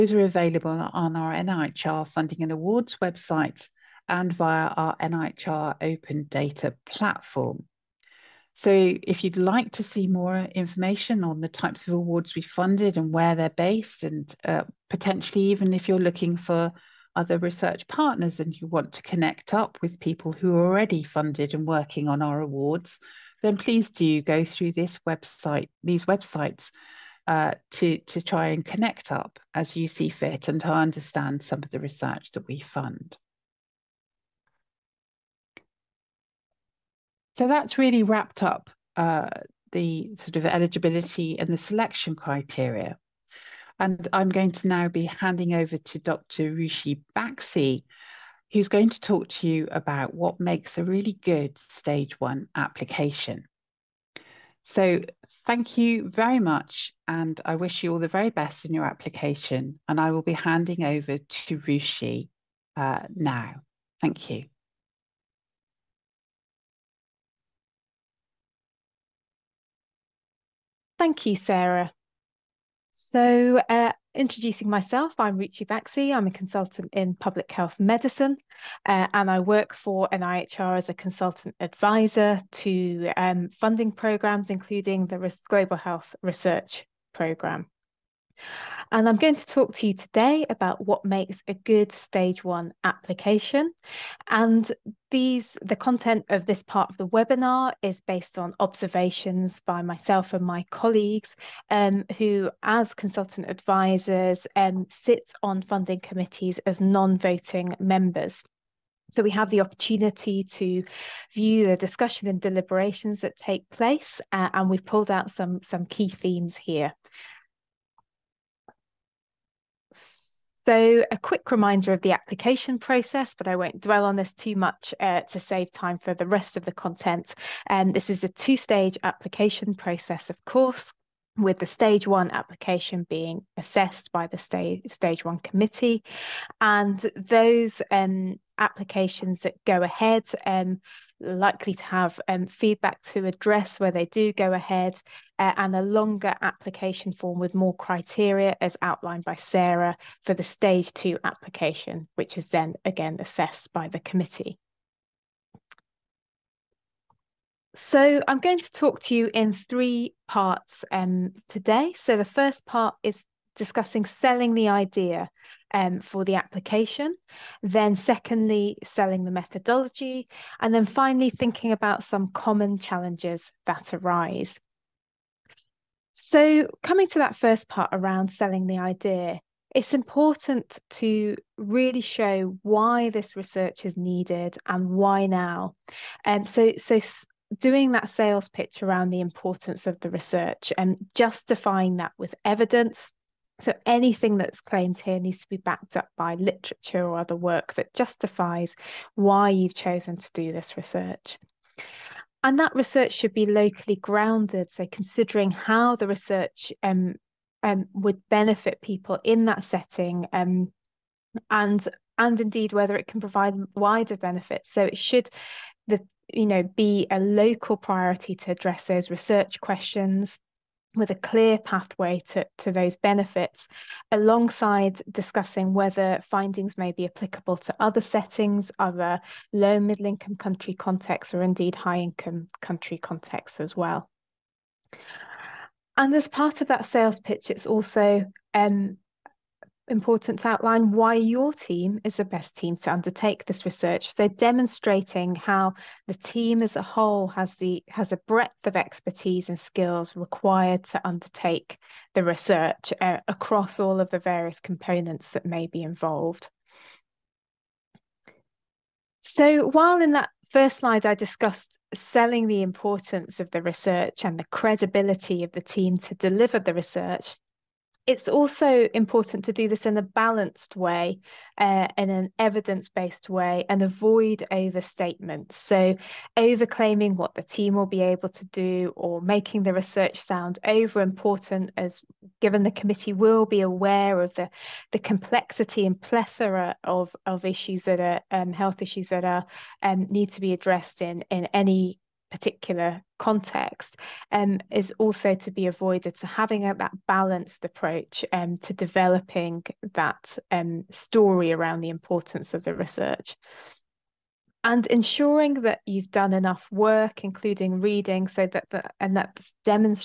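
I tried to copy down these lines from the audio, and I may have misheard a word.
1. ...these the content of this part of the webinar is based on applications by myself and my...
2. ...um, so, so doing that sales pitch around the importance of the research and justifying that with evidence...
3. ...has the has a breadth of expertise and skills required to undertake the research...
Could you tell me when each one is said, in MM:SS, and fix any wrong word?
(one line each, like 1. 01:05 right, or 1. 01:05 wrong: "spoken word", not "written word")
1. 01:35 wrong: "observations", not "applications"
2. 03:06 right
3. 04:07 right.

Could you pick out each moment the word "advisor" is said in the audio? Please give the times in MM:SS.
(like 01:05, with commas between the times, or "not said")
01:21, 01:43.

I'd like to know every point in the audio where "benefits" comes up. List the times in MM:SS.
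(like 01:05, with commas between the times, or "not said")
03:28, 03:34, 03:42.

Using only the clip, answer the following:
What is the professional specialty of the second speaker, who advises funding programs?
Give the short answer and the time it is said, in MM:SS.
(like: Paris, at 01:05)
public health medicine, at 01:17.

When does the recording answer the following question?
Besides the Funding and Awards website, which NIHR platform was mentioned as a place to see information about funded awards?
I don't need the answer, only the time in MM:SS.
00:04.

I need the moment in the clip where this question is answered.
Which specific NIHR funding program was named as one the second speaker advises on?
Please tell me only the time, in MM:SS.
01:25.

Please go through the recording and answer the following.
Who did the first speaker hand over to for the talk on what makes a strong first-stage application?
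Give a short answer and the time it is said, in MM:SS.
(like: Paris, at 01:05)
Dr. Ruchi Baxi, at 00:45.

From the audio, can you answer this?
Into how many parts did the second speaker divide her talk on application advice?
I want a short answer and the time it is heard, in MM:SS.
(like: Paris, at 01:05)
3, at 02:39.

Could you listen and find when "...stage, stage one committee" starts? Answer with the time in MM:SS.
02:14.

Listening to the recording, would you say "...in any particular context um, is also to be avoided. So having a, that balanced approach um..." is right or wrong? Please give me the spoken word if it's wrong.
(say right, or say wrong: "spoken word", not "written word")
right.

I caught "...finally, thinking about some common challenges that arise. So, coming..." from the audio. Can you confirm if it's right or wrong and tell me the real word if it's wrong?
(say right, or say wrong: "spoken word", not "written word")
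right.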